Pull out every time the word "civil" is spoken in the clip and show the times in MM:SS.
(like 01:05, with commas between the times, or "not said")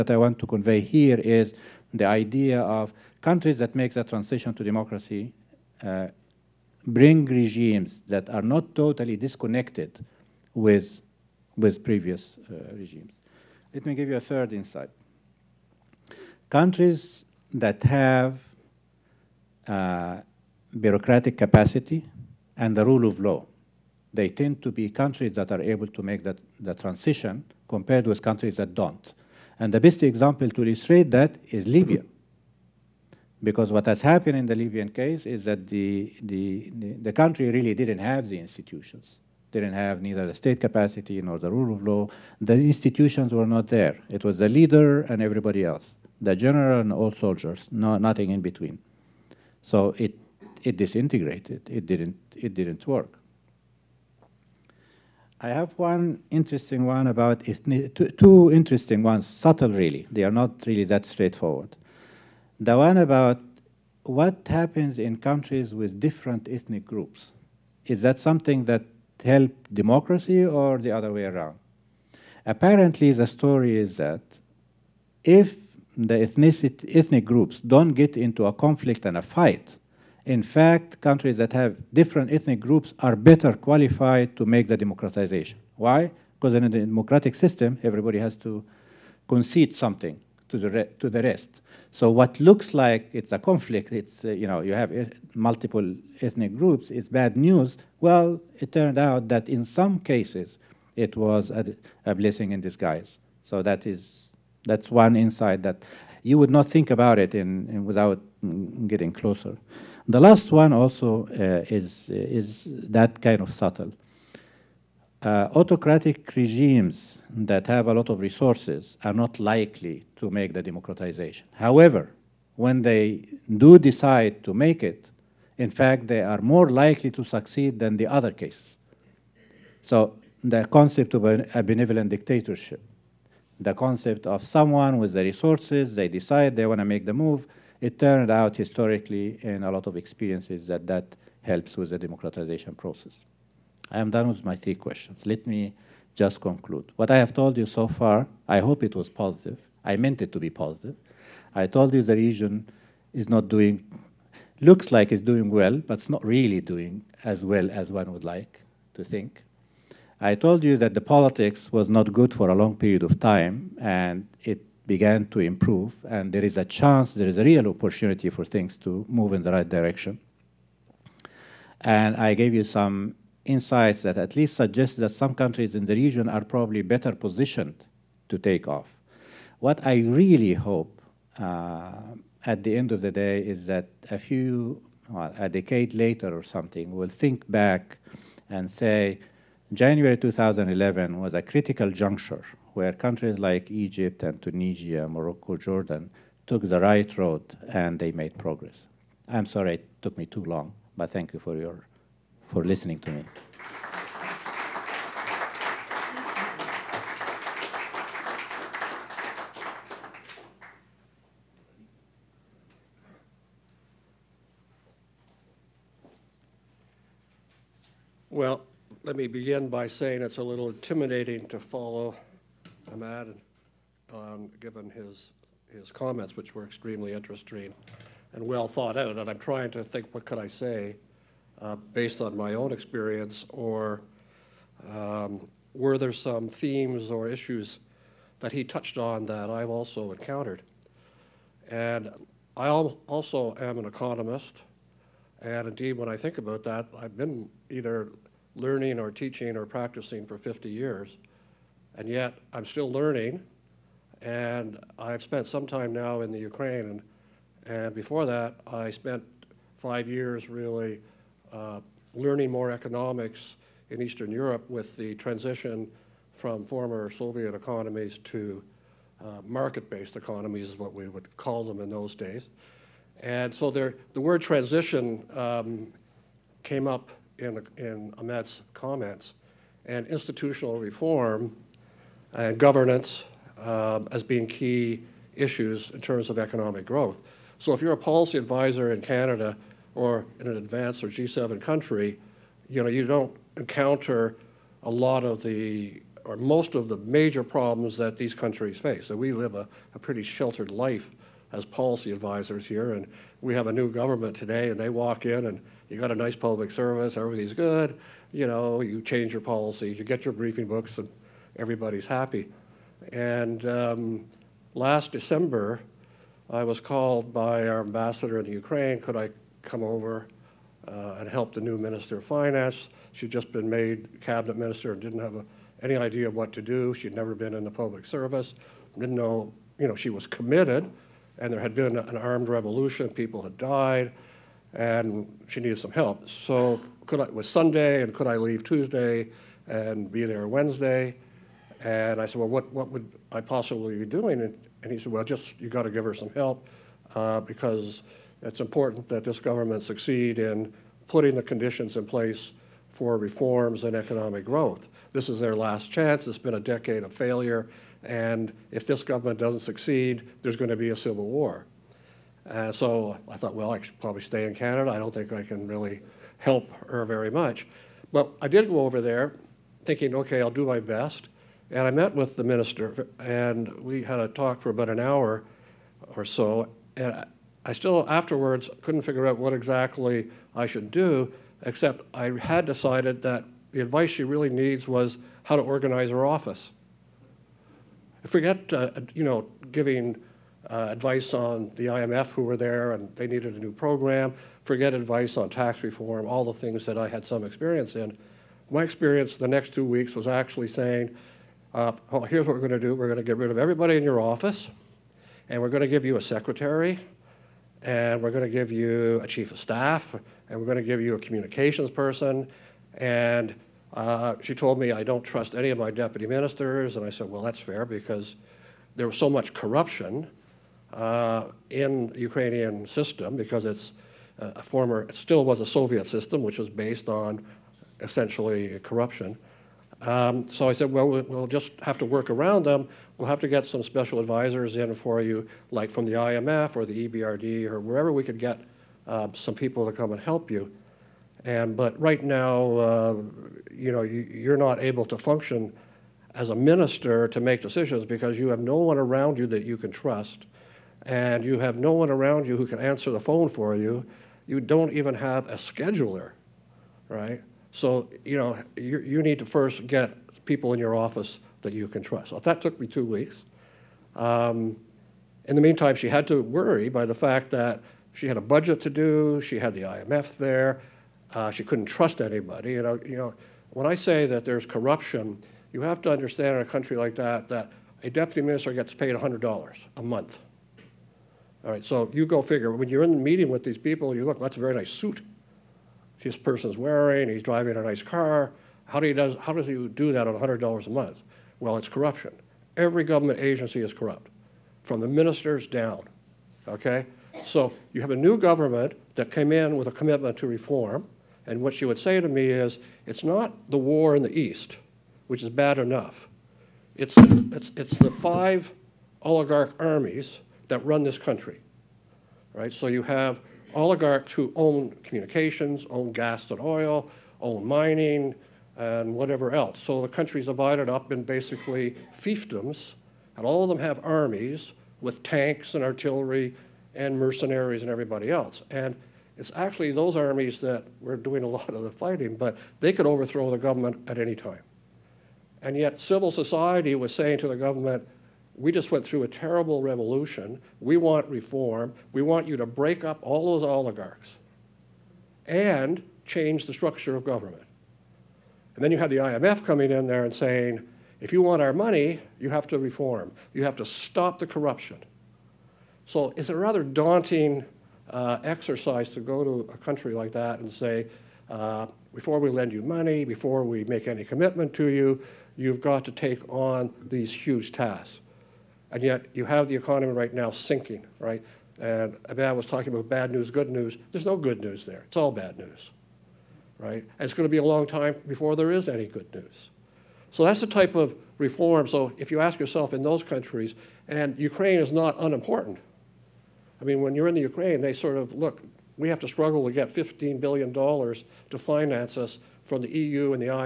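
06:00, 08:55.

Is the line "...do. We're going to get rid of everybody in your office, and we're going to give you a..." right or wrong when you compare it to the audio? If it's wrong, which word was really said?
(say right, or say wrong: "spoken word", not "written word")
right.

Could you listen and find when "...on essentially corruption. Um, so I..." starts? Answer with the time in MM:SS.
07:07.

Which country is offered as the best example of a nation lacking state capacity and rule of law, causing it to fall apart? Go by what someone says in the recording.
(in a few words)
Libya.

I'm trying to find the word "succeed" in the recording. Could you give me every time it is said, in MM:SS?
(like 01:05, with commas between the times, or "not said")
02:07, 05:49, 05:59.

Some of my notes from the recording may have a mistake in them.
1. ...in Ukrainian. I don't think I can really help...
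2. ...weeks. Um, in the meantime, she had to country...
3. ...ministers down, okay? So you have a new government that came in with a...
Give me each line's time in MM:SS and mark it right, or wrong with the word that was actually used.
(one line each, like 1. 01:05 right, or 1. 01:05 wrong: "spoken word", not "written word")
1. 06:04 wrong: "Canada", not "Ukrainian"
2. 07:43 wrong: "worry", not "country"
3. 08:15 right.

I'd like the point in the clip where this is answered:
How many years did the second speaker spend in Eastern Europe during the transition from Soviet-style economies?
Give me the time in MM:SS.
04:19.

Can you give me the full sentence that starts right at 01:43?
So that is, that's one insight that you would not think about it in, in without mm, getting closer.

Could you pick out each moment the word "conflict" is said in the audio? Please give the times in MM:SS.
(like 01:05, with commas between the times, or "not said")
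01:18, 01:33.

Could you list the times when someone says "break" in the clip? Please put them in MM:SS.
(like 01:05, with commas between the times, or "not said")
09:02.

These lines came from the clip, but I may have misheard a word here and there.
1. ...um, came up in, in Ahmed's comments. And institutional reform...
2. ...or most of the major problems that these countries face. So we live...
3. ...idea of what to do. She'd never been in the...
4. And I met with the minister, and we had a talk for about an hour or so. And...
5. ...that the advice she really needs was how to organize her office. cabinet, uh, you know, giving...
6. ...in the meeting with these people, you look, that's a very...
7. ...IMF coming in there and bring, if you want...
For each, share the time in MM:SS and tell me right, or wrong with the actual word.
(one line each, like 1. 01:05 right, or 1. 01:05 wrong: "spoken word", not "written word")
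1. 04:35 right
2. 04:56 right
3. 05:25 right
4. 06:11 right
5. 06:23 wrong: "forget", not "cabinet"
6. 08:03 right
7. 09:09 wrong: "saying", not "bring".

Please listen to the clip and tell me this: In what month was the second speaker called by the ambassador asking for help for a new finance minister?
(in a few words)
December.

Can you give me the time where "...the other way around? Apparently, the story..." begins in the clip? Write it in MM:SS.
01:10.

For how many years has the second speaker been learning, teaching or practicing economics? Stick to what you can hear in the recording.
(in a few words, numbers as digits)
50.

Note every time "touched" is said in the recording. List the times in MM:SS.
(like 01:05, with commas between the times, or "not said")
03:58.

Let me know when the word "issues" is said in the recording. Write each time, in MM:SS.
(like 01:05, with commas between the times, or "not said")
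03:57, 04:45.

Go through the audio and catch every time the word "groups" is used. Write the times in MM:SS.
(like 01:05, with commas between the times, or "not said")
01:06, 01:17, 01:22, 01:36.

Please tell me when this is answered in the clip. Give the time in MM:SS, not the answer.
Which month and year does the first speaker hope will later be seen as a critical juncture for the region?
03:09.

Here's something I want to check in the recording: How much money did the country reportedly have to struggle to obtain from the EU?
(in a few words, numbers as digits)
$15 billion.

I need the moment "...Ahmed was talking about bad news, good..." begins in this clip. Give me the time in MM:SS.
09:32.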